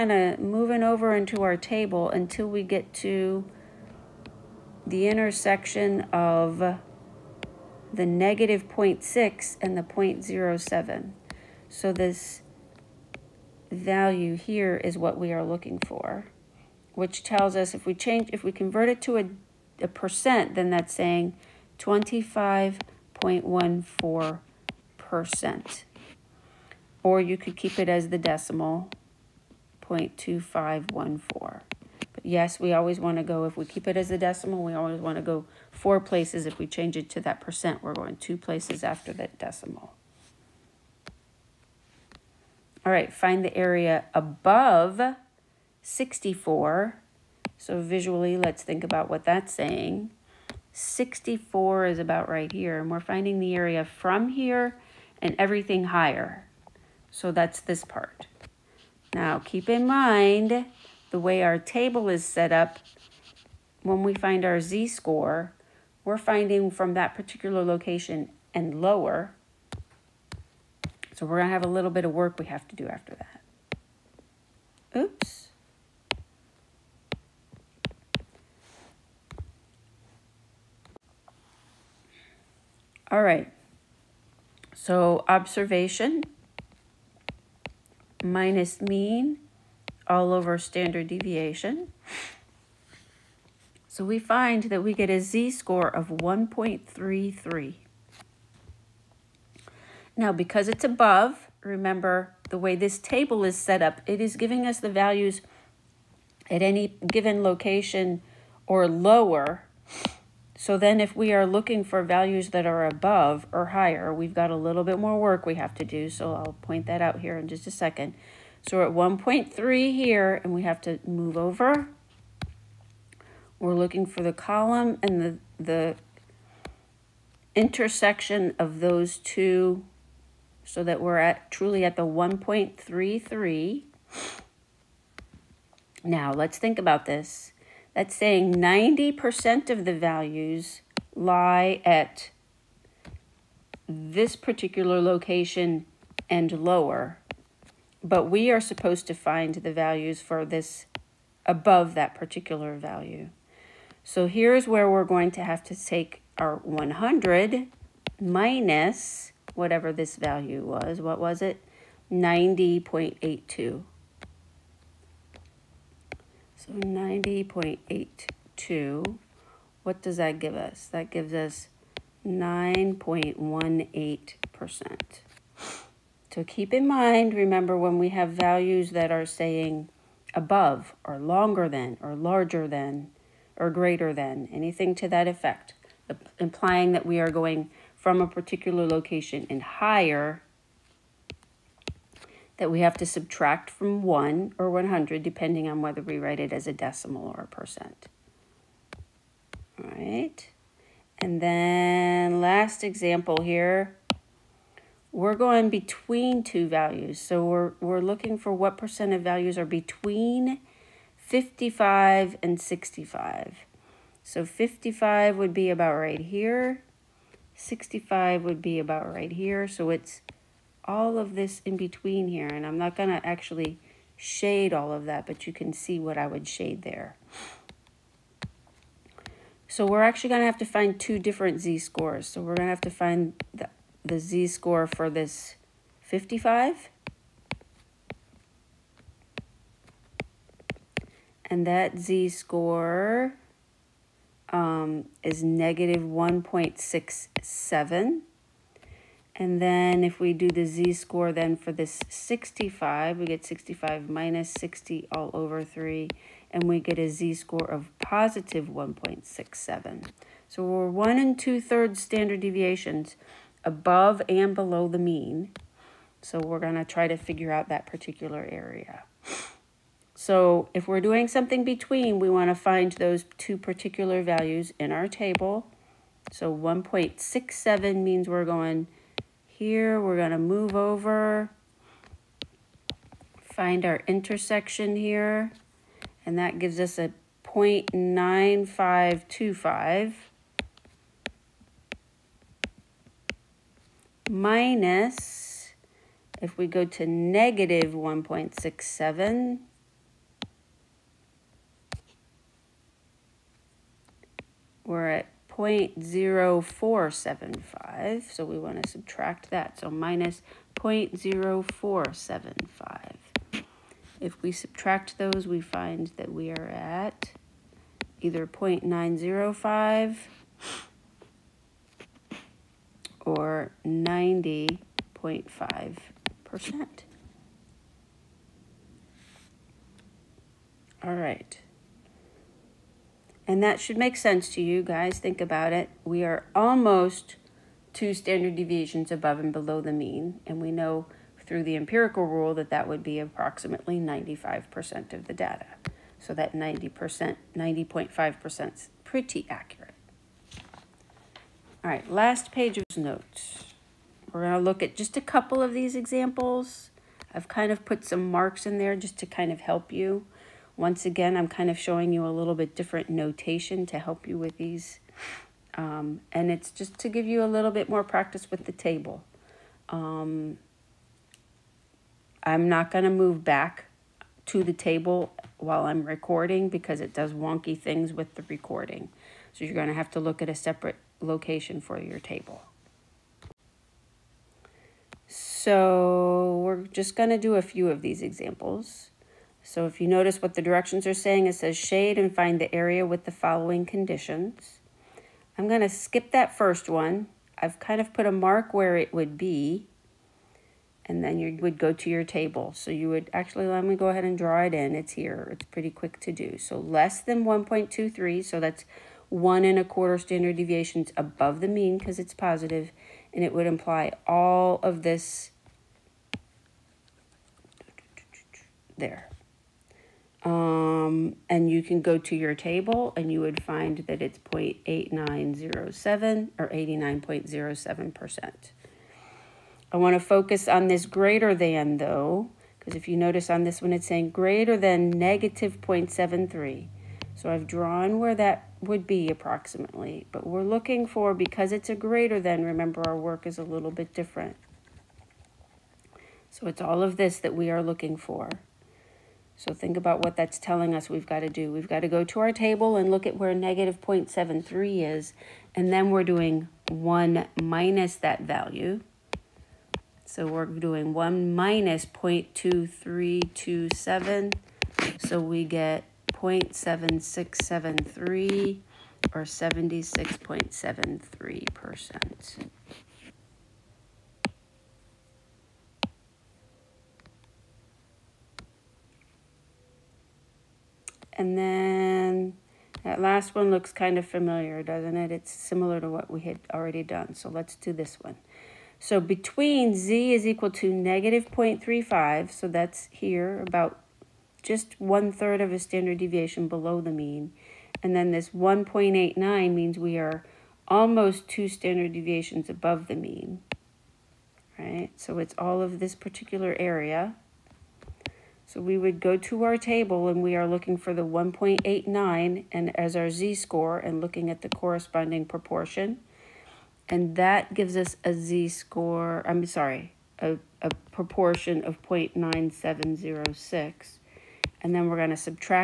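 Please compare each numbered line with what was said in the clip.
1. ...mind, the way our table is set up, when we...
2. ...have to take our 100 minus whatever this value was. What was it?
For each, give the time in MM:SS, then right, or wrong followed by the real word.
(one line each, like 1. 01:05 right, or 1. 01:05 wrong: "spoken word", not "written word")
1. 00:59 right
2. 02:35 right.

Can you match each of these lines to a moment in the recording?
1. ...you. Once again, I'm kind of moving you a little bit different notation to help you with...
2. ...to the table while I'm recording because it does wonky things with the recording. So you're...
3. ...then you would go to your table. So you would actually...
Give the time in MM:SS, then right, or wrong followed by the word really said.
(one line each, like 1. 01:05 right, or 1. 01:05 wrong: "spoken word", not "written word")
1. 05:59 wrong: "showing", not "moving"
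2. 06:14 right
3. 06:41 right.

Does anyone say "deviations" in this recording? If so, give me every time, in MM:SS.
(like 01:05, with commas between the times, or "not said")
01:31, 04:22, 05:38, 06:50, 08:16, 08:22.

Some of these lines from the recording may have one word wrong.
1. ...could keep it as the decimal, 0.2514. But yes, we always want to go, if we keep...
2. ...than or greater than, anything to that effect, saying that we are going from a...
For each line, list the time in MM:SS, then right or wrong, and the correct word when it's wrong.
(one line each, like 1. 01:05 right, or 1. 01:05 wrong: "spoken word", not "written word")
1. 00:27 right
2. 03:02 wrong: "implying", not "saying".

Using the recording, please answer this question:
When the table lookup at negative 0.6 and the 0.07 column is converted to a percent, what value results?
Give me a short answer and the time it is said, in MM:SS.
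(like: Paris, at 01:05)
25.14%, at 00:21.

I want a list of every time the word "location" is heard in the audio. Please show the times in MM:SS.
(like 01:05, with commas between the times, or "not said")
01:07, 01:47, 02:25, 03:08, 06:21.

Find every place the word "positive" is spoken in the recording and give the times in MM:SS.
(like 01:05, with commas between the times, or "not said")
04:17, 06:52.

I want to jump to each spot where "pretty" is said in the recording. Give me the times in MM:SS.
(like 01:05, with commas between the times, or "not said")
05:49, 06:45.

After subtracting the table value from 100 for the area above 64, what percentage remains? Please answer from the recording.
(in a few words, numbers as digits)
9.18%.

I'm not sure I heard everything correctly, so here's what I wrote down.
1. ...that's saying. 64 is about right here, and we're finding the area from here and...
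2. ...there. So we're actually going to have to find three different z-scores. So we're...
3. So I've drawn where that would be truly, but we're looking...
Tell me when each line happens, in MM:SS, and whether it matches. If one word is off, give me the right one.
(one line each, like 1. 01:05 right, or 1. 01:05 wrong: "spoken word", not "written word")
1. 00:49 right
2. 03:46 wrong: "two", not "three"
3. 07:17 wrong: "approximately", not "truly".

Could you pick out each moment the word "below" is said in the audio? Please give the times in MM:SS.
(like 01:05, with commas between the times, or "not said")
04:24, 05:39, 08:16.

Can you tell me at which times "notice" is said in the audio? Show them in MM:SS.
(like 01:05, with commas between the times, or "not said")
06:30, 07:13.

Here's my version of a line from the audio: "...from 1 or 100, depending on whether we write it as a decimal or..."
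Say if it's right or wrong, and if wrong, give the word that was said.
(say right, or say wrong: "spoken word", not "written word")
right.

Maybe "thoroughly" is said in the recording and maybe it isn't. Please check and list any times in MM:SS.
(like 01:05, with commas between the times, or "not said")
not said.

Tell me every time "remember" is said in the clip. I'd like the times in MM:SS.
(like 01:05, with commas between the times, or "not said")
01:41, 02:57, 07:22.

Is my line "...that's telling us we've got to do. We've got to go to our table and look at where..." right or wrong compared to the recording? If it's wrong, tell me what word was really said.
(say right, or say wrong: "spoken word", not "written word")
right.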